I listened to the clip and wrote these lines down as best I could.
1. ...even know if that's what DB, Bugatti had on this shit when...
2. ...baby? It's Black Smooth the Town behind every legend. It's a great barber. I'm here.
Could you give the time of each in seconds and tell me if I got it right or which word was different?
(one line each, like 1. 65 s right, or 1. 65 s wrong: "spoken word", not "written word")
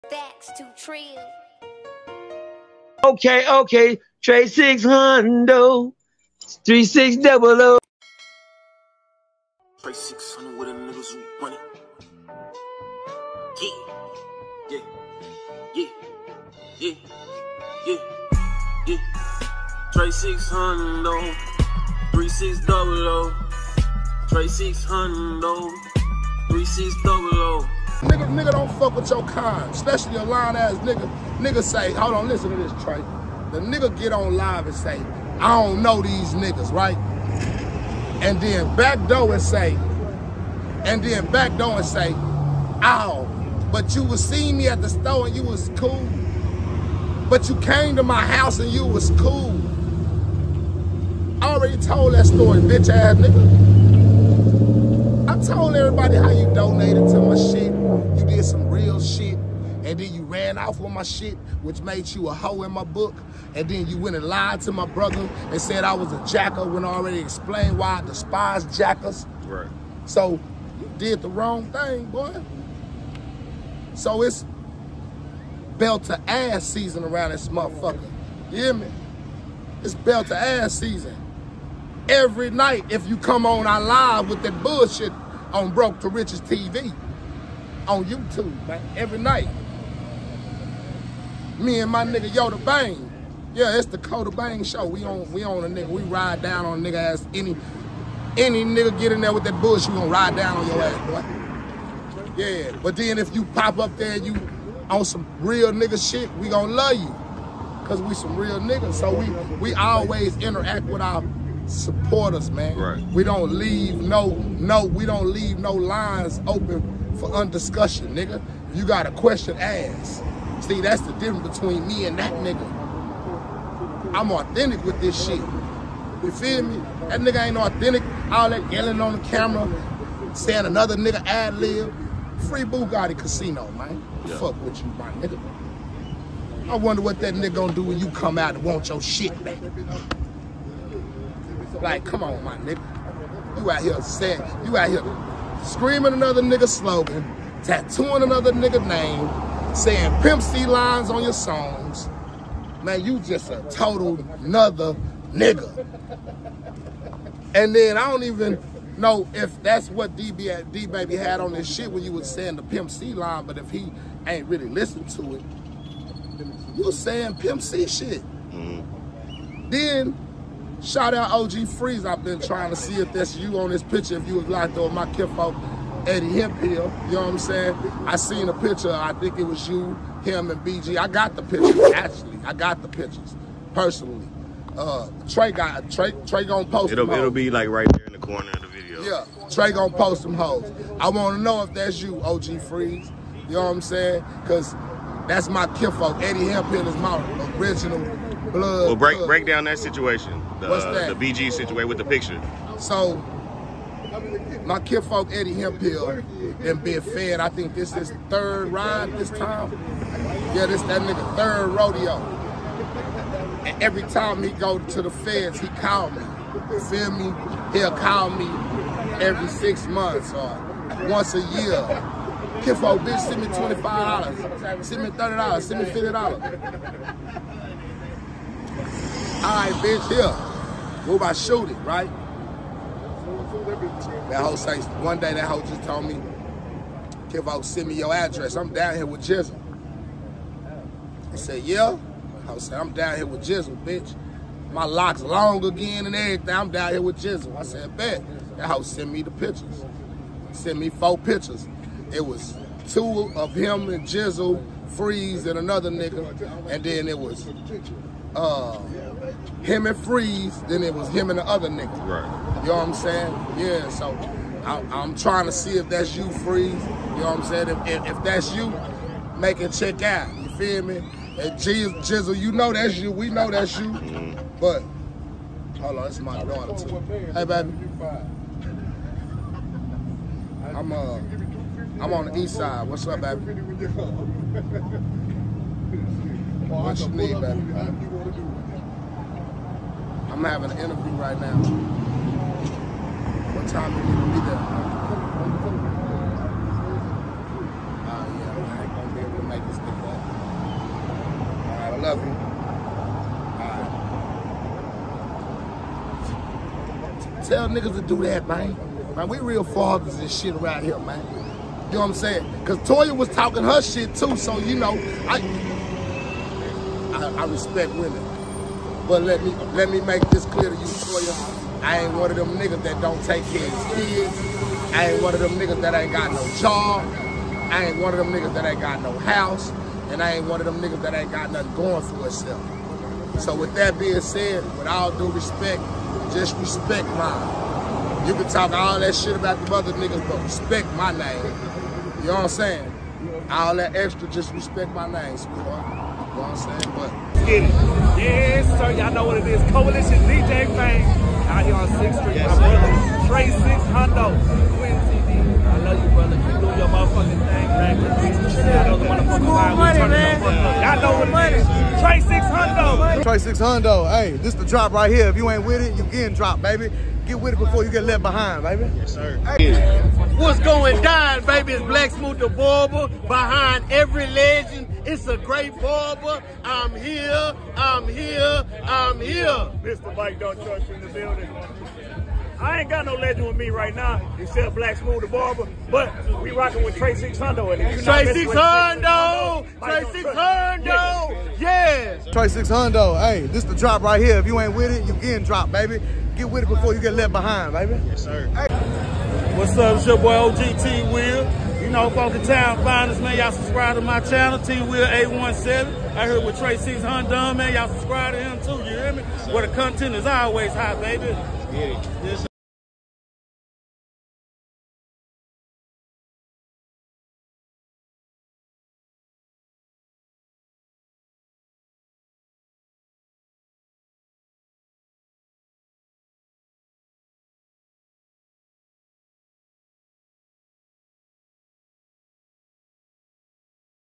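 1. 158 s wrong: "DaBaby", not "Bugatti"
2. 371 s wrong: "Barber", not "Town".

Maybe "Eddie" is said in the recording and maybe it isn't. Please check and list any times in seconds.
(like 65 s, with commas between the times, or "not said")
176 s, 196 s, 205 s.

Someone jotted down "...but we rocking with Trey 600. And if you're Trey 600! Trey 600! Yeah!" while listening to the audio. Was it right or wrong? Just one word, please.
right.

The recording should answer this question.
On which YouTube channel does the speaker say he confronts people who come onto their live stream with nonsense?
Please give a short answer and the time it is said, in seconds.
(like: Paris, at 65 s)
Broke to Riches TV, at 85 s.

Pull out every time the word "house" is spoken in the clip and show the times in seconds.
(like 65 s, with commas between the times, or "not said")
48 s, 329 s.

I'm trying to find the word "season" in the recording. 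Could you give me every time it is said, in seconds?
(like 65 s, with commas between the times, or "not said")
76 s, 80 s.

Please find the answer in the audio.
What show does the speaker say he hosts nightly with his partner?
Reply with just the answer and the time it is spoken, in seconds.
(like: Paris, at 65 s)
Coda Bang show, at 93 s.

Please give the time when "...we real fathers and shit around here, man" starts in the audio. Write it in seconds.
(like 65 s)
309 s.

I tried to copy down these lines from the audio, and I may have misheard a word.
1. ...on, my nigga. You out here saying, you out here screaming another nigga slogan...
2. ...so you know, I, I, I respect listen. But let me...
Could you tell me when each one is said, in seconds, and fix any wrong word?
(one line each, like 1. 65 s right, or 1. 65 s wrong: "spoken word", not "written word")
1. 142 s right
2. 314 s wrong: "women", not "listen".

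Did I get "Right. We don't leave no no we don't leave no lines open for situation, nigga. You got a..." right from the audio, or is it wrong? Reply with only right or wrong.
wrong.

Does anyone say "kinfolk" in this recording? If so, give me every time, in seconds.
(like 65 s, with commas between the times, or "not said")
175 s, 195 s, 204 s, 222 s.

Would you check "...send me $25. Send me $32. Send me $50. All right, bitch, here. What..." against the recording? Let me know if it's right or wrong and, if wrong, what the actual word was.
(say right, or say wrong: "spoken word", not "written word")
wrong: "30", not "32".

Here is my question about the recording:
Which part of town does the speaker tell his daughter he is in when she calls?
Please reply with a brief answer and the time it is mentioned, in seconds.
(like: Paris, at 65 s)
east side, at 282 s.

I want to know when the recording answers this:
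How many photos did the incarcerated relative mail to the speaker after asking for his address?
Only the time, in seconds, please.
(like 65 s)
250 s.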